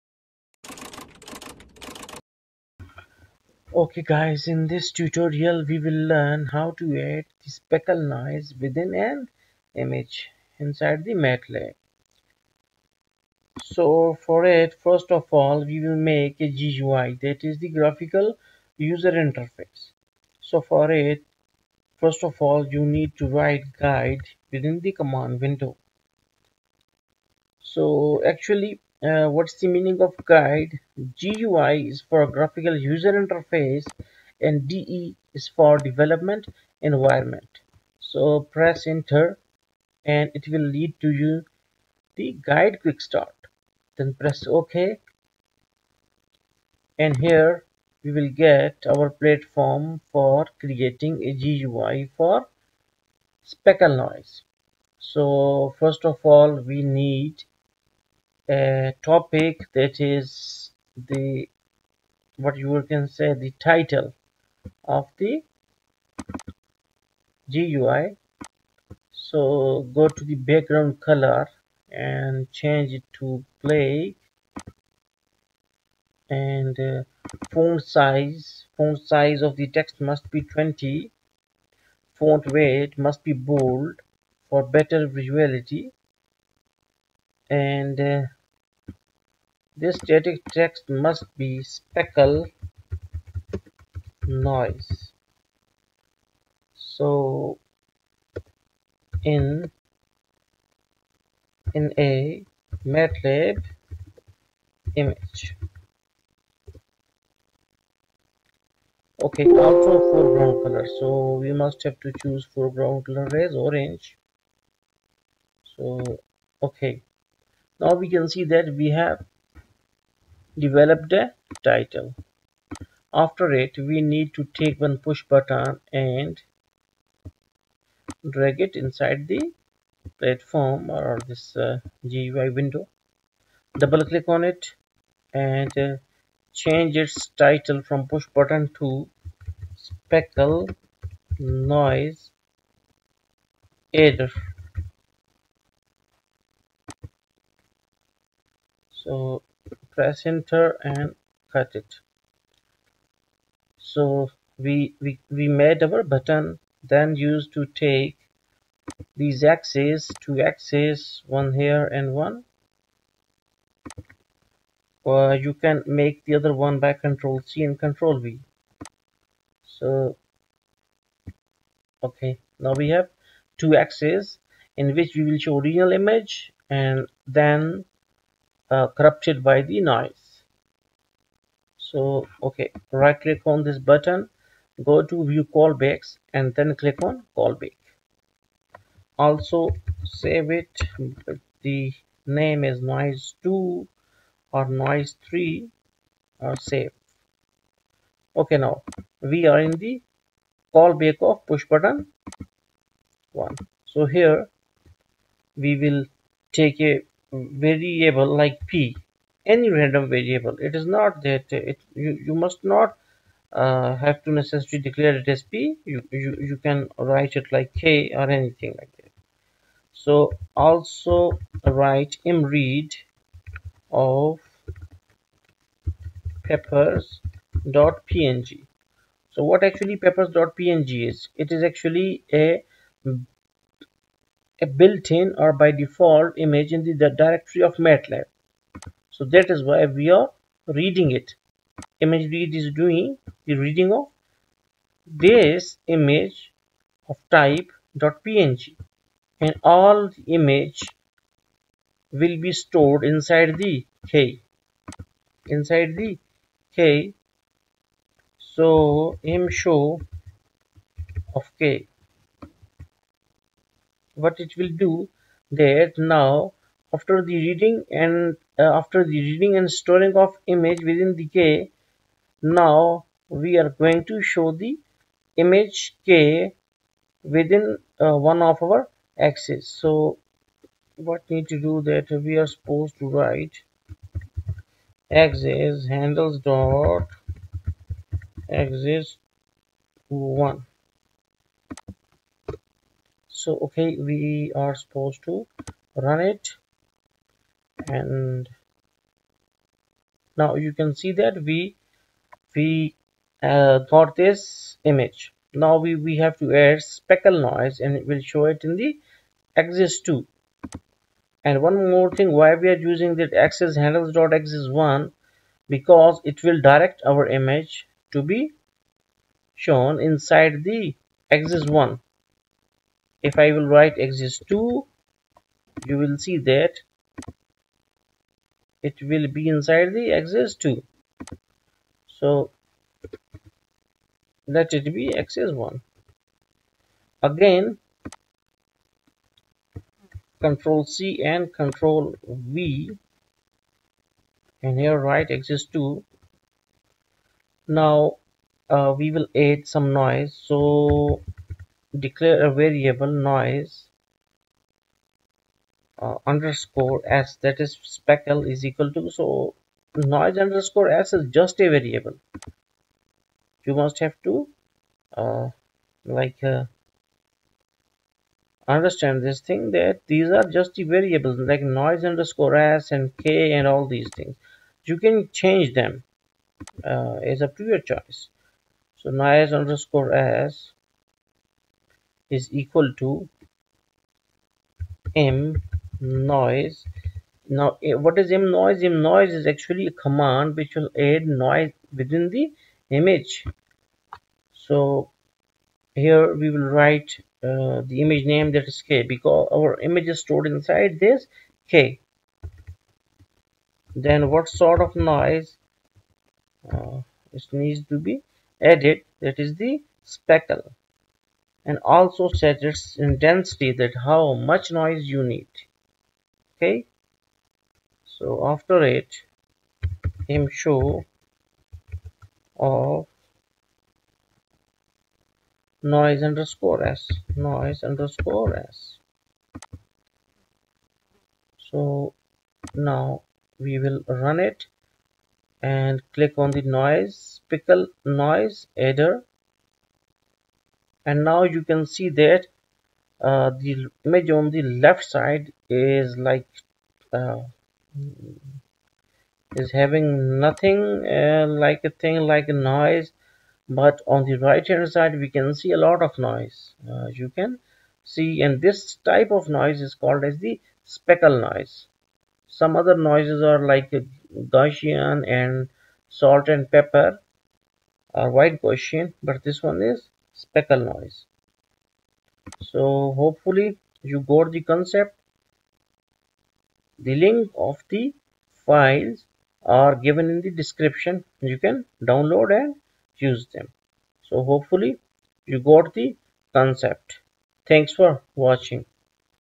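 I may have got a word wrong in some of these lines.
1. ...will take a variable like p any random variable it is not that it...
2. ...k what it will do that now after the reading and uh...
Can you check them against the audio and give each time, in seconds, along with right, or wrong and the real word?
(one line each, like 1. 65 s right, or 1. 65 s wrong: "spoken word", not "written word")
1. 205 s right
2. 261 s right.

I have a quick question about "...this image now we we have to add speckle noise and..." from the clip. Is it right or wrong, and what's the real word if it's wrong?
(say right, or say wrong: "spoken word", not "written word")
right.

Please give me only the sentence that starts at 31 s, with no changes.
GUI is for graphical user interface and DE is for development environment.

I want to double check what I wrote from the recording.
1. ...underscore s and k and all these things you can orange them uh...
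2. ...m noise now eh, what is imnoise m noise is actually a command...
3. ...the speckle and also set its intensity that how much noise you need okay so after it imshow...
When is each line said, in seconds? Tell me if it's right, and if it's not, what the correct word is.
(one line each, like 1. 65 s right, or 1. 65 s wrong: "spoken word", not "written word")
1. 372 s wrong: "change", not "orange"
2. 385 s right
3. 409 s right.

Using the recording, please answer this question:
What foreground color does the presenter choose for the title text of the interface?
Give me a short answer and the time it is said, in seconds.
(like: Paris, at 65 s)
Orange, at 113 s.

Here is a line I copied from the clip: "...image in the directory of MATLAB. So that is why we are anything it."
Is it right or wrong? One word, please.
wrong.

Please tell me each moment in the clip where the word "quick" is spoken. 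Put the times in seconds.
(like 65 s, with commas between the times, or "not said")
42 s.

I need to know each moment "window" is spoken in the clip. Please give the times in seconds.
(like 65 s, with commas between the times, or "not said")
25 s, 132 s.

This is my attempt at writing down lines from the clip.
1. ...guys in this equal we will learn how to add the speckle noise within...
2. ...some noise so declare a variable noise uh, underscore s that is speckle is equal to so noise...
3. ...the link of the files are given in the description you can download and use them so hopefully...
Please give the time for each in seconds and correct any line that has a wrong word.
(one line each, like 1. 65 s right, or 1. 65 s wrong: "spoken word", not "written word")
1. 4 s wrong: "tutorial", not "equal"
2. 349 s right
3. 477 s right.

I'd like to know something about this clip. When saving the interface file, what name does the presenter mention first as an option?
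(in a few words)
noise 2.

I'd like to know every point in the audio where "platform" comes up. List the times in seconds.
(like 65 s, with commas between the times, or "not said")
49 s, 130 s.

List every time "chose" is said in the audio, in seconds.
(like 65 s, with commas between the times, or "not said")
not said.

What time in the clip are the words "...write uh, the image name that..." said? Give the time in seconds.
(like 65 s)
396 s.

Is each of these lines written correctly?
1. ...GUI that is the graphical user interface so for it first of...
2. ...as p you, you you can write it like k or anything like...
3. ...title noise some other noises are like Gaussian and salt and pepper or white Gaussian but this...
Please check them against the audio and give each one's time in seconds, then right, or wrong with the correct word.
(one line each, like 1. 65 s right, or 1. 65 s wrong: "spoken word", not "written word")
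1. 16 s right
2. 215 s right
3. 460 s wrong: "speckle", not "title".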